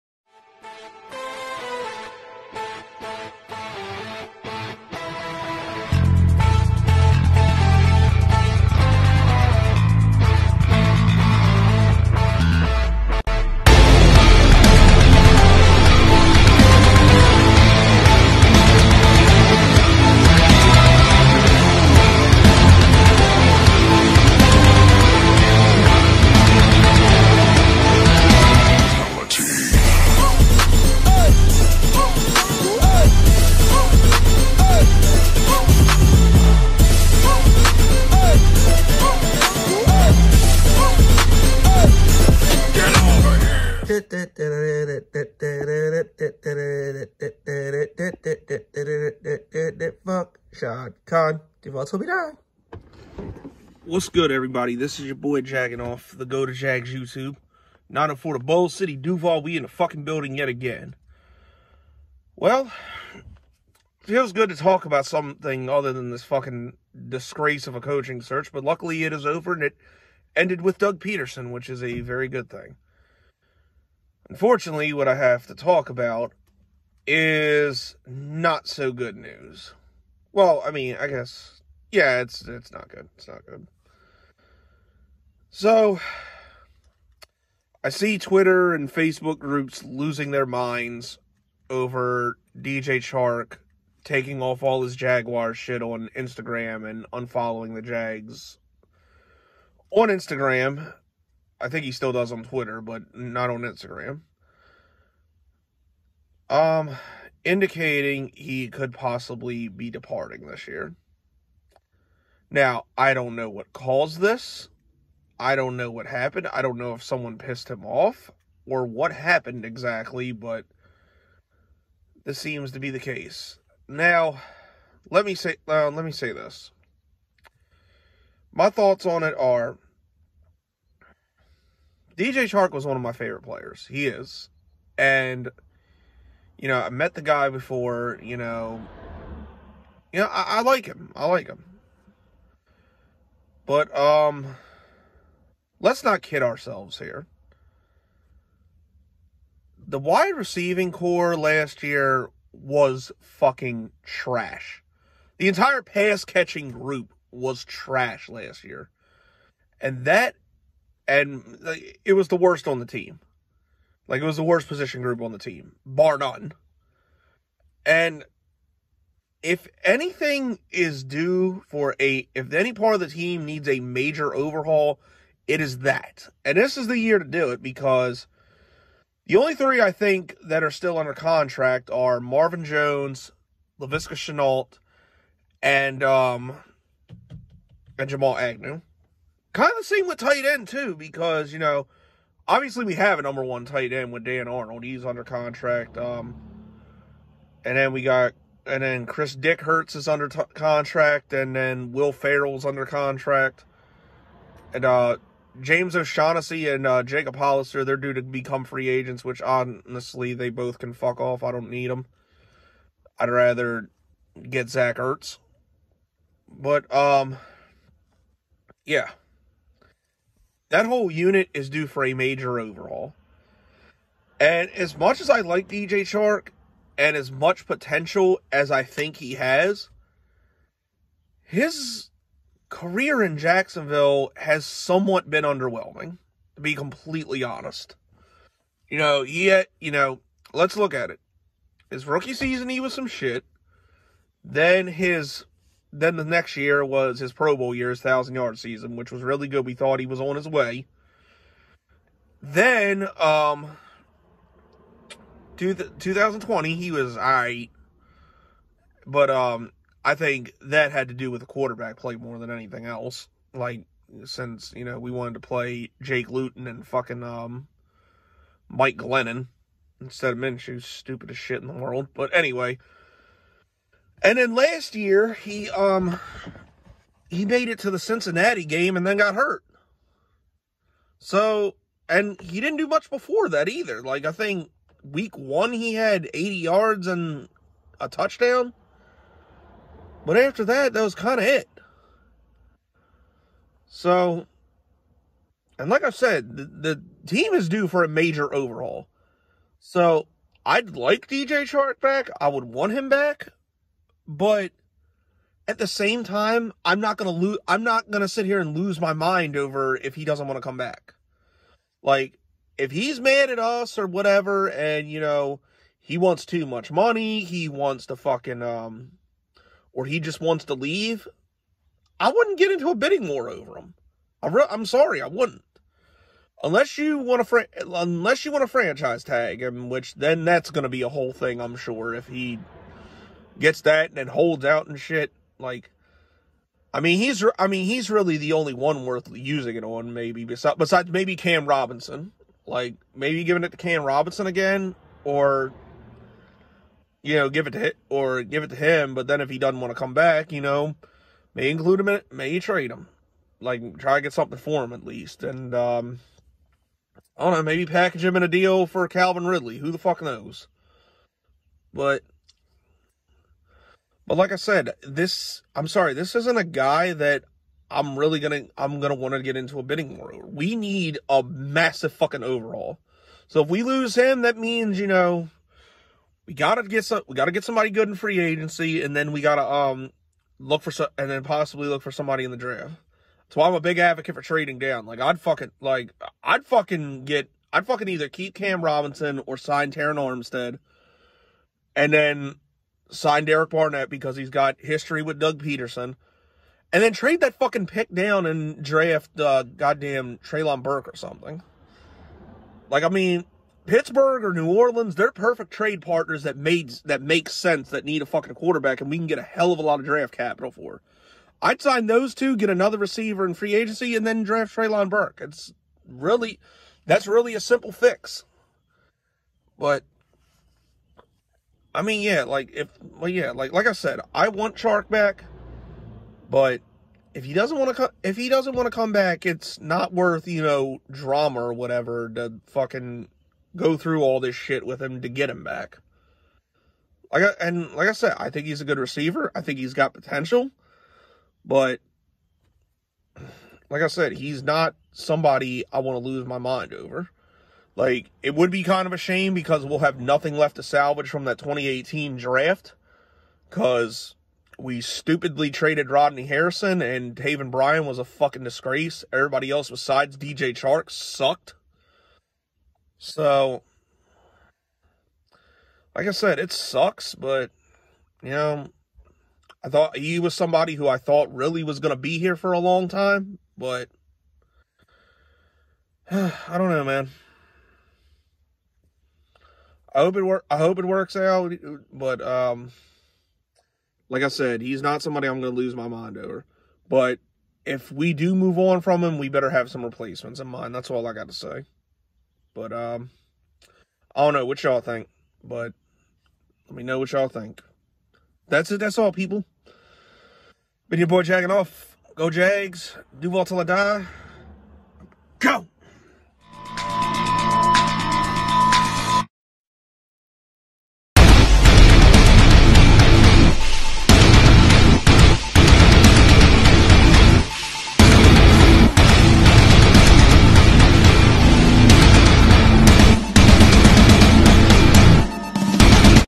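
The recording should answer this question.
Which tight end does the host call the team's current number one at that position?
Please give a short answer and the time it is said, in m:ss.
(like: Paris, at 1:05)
Dan Arnold, at 3:14.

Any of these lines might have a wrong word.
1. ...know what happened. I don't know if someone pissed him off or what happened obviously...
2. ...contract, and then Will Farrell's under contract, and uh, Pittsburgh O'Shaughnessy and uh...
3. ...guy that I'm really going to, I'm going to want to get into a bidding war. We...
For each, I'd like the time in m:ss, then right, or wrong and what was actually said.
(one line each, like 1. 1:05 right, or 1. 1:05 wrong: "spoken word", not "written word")
1. 1:55 wrong: "exactly", not "obviously"
2. 3:20 wrong: "James", not "Pittsburgh"
3. 6:06 right.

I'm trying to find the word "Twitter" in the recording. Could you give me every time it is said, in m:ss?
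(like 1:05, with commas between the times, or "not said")
1:28, 1:42.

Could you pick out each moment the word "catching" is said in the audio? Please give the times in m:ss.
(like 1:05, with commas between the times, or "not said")
2:36.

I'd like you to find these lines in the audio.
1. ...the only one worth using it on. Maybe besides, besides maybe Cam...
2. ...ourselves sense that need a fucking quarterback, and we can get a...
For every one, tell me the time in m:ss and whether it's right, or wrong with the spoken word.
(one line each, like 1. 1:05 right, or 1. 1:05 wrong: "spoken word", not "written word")
1. 5:38 right
2. 6:47 wrong: "makes", not "ourselves".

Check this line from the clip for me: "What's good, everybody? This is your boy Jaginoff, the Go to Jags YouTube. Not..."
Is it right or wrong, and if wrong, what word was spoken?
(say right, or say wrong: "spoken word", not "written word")
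right.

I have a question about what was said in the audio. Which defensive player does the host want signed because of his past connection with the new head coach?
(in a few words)
Derek Barnett.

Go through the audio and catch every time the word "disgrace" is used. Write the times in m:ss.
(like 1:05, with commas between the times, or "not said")
1:07, 7:38.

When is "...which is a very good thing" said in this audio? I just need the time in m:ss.
1:11.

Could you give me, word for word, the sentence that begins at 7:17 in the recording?
Like I, and like I said, I think he's a good receiver.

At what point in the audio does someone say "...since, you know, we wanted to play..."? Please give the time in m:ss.
4:24.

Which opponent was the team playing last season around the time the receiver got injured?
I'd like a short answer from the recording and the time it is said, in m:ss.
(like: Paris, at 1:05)
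Cincinnati, at 4:37.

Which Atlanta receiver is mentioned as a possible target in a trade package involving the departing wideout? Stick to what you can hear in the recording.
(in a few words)
Calvin Ridley.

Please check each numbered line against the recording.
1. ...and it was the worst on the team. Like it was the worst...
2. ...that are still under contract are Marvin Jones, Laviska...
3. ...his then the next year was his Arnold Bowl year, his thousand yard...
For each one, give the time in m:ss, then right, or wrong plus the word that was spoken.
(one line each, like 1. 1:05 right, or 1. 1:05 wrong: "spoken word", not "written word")
1. 2:41 right
2. 3:00 right
3. 4:04 wrong: "Pro", not "Arnold".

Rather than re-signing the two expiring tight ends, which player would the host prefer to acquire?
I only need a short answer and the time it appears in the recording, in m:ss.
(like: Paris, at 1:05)
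Zach Ertz, at 3:34.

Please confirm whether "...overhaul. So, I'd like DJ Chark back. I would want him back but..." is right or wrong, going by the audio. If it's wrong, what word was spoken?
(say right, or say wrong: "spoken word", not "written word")
right.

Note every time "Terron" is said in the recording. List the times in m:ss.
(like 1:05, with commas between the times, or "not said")
6:29.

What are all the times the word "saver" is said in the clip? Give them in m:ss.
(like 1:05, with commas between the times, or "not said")
not said.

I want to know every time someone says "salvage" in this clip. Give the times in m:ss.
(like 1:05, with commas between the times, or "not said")
7:30.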